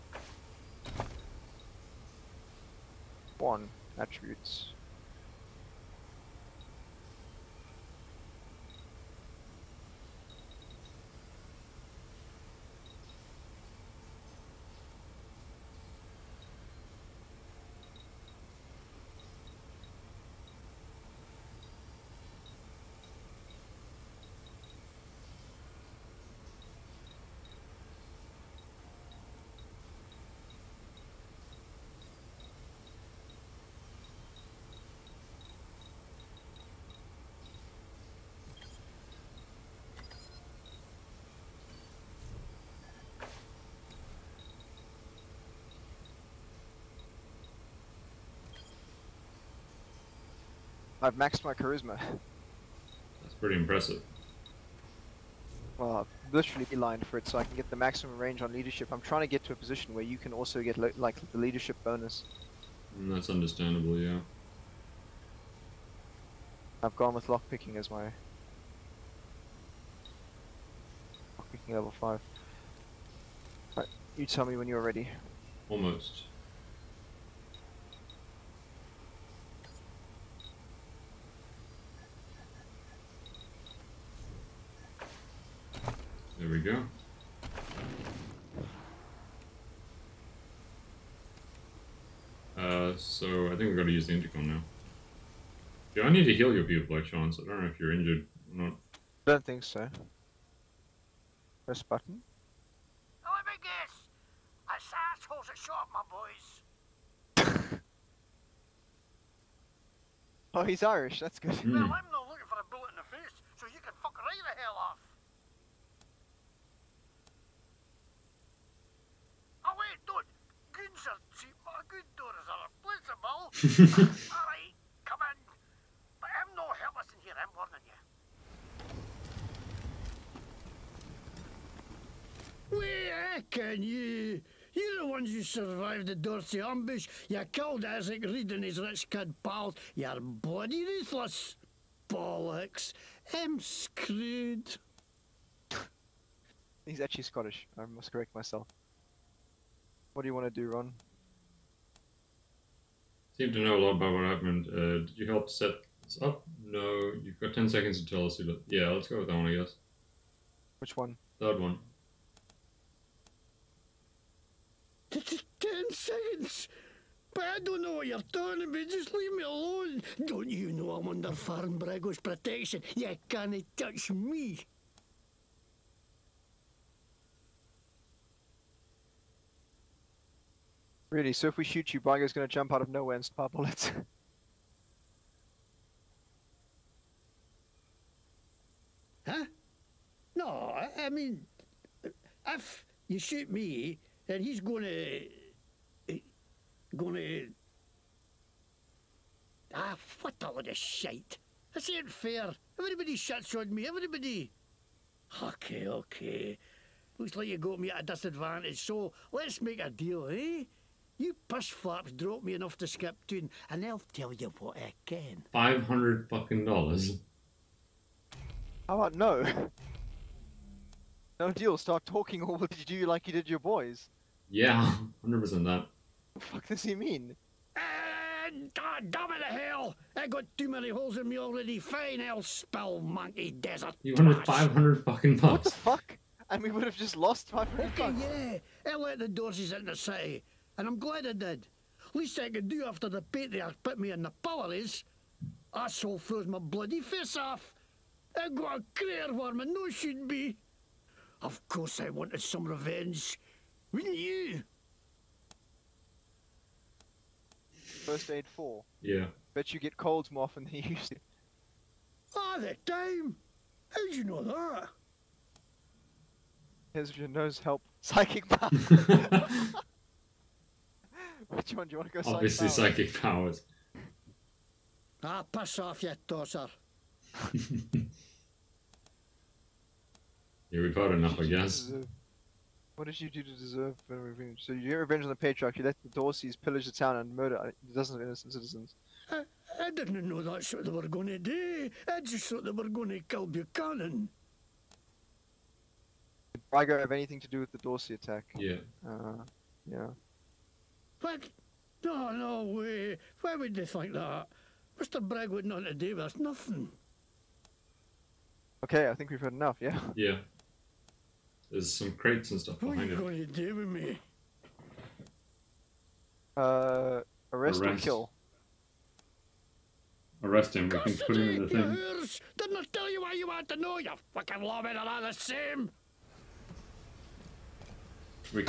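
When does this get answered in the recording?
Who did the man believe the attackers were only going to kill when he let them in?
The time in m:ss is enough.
4:53.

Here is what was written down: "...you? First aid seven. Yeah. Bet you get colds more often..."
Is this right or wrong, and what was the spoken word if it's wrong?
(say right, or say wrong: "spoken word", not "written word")
wrong: "four", not "seven".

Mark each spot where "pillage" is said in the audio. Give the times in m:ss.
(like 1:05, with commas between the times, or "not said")
4:46.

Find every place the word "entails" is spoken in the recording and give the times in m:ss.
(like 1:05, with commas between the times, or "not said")
not said.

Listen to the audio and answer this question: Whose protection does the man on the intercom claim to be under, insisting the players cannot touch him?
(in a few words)
Faran Brygo.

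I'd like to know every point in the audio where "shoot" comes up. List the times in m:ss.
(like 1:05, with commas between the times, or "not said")
3:01, 3:13.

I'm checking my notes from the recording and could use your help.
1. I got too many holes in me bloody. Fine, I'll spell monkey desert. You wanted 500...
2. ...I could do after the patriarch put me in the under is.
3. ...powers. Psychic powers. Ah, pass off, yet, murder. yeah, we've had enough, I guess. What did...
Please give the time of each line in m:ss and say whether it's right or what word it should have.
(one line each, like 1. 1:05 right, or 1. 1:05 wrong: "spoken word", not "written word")
1. 3:50 wrong: "already", not "bloody"
2. 4:02 wrong: "power", not "under"
3. 4:33 wrong: "daughter", not "murder".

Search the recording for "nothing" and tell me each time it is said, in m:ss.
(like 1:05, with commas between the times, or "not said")
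5:06.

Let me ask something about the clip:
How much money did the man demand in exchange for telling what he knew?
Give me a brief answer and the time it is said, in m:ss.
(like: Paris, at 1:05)
$500, at 3:35.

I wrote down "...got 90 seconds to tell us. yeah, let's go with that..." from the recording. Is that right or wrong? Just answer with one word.
wrong.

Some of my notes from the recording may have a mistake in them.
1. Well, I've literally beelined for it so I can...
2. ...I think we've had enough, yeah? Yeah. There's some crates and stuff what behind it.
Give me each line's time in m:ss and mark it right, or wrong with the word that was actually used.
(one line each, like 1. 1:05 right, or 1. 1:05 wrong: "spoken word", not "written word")
1. 0:55 right
2. 5:09 right.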